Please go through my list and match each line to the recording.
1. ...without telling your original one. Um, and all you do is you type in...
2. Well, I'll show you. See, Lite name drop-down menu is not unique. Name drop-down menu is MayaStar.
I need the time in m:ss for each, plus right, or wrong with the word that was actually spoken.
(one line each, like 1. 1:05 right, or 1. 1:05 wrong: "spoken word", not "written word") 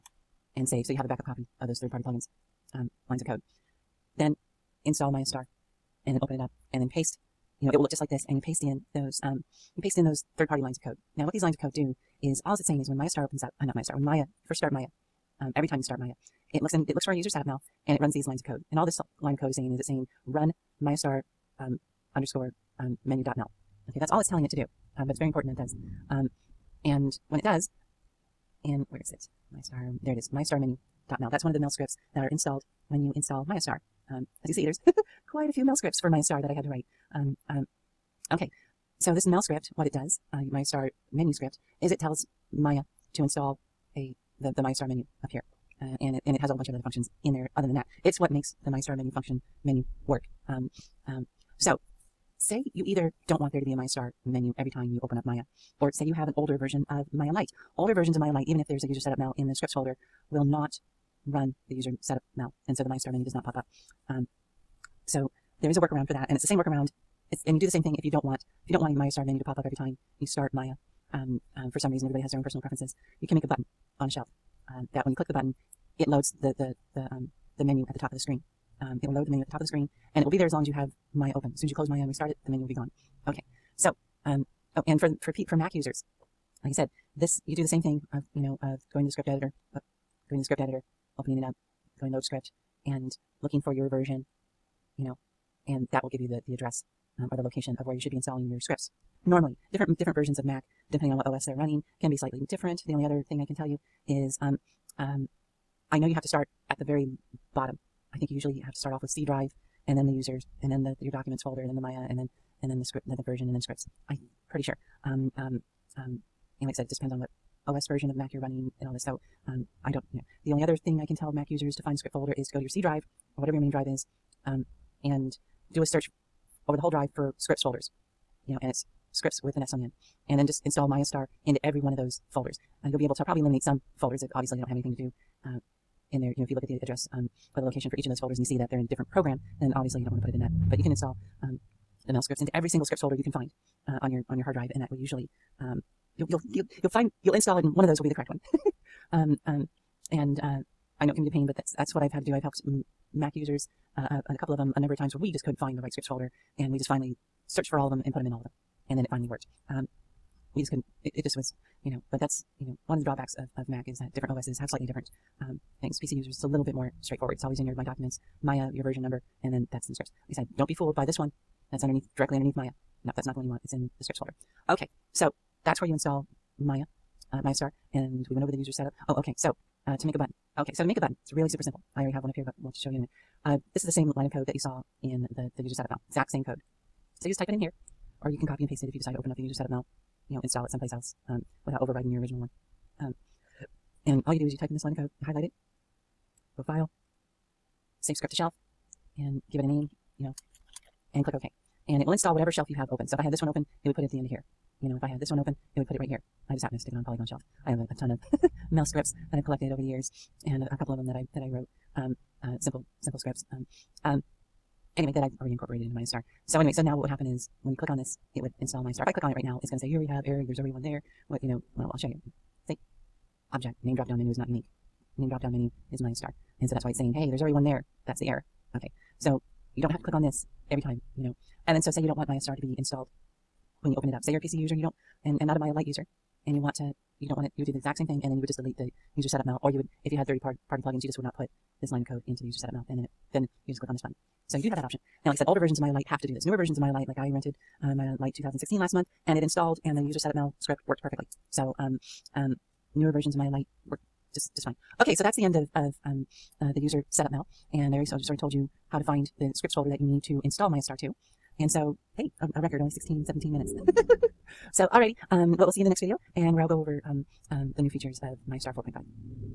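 1. 3:11 wrong: "overriding", not "telling"
2. 3:41 wrong: "Object", not "Lite".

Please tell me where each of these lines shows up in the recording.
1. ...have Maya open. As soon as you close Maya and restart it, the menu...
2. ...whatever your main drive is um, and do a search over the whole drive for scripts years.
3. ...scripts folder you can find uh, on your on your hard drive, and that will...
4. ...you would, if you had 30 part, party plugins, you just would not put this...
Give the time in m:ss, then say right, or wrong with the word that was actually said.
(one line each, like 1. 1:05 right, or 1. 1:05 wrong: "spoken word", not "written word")
1. 1:20 right
2. 2:03 wrong: "folders", not "years"
3. 2:22 right
4. 3:59 right.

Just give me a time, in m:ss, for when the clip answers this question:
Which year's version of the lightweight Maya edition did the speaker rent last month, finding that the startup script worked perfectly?
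4:07.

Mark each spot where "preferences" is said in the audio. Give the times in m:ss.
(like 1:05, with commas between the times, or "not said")
1:12.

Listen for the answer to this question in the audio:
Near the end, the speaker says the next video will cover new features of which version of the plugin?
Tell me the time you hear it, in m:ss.
4:28.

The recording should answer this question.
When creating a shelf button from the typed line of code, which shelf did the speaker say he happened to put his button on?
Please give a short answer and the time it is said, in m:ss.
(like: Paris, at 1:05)
Polygon Shelf, at 3:27.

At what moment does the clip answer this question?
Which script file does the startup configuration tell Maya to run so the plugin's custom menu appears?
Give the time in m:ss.
0:20.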